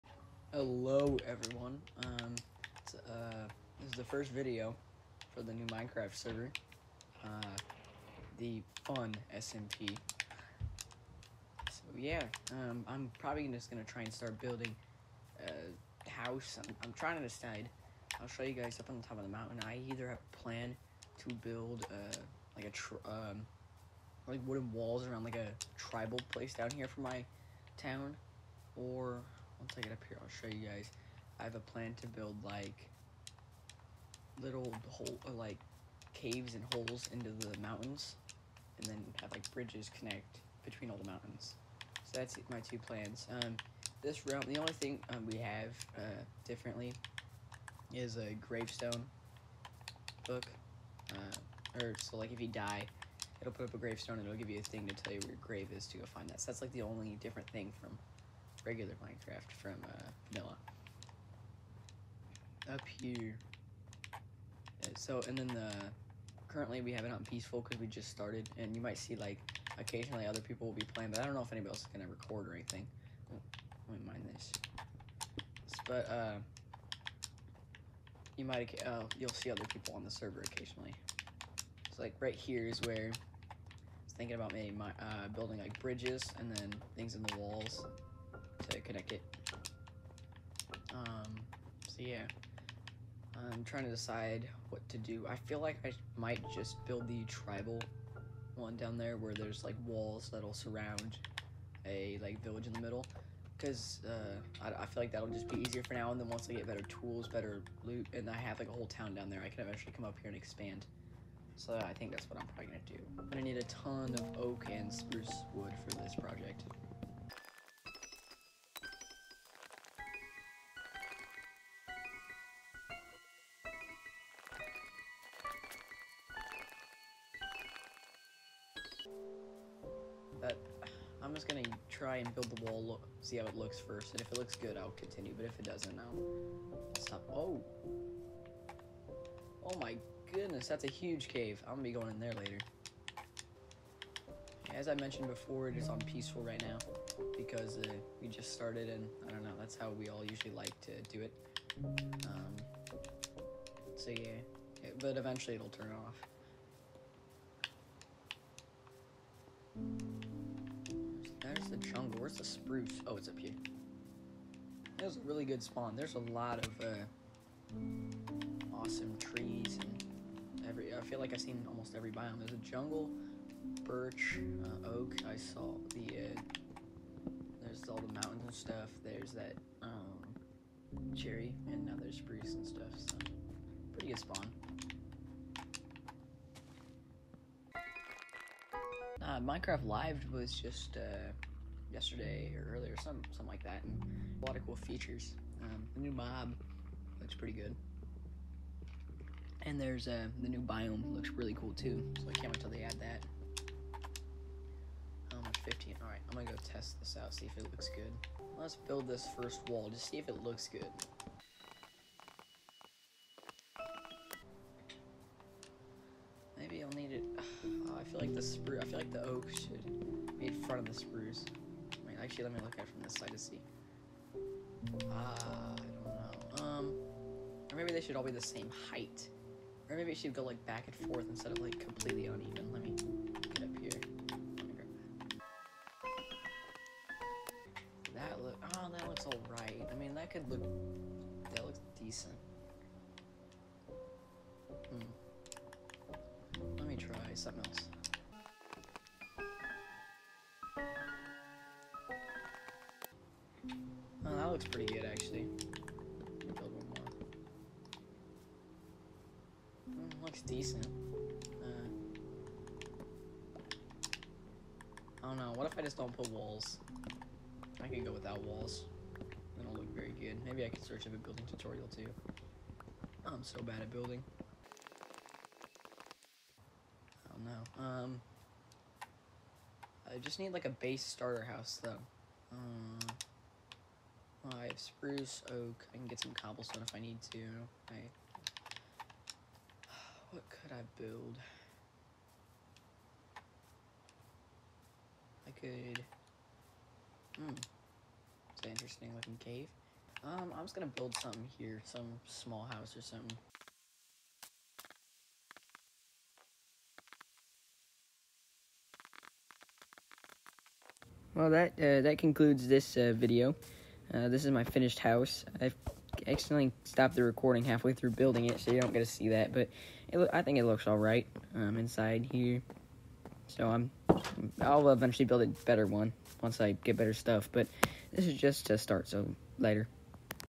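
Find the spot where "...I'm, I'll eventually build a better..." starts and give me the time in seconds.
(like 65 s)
323 s.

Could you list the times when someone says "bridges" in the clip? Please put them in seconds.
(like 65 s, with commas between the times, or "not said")
39 s, 85 s.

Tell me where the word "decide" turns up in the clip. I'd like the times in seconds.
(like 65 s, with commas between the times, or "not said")
17 s, 93 s.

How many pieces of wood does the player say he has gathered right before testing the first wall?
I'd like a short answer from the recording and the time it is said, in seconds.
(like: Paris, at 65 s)
15, at 205 s.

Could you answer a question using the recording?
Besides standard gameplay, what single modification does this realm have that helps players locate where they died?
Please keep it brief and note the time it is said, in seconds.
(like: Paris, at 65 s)
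Gravestone book, at 48 s.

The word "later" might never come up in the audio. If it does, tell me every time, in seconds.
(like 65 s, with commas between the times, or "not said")
142 s, 329 s.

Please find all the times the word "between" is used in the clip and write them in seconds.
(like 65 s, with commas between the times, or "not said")
40 s.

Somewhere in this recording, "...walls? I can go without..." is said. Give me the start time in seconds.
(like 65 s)
266 s.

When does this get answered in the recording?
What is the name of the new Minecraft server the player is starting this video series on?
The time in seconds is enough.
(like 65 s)
8 s.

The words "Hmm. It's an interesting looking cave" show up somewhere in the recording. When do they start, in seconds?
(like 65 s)
297 s.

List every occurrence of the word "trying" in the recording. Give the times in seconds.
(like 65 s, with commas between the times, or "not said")
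16 s, 93 s.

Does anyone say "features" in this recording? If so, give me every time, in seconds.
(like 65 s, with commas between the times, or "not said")
194 s.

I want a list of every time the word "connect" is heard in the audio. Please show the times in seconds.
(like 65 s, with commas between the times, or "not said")
39 s, 88 s.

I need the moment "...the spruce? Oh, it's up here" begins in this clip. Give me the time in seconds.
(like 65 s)
162 s.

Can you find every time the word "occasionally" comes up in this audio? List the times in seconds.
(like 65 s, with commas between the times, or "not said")
69 s, 80 s.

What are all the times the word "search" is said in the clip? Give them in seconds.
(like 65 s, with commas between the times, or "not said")
270 s.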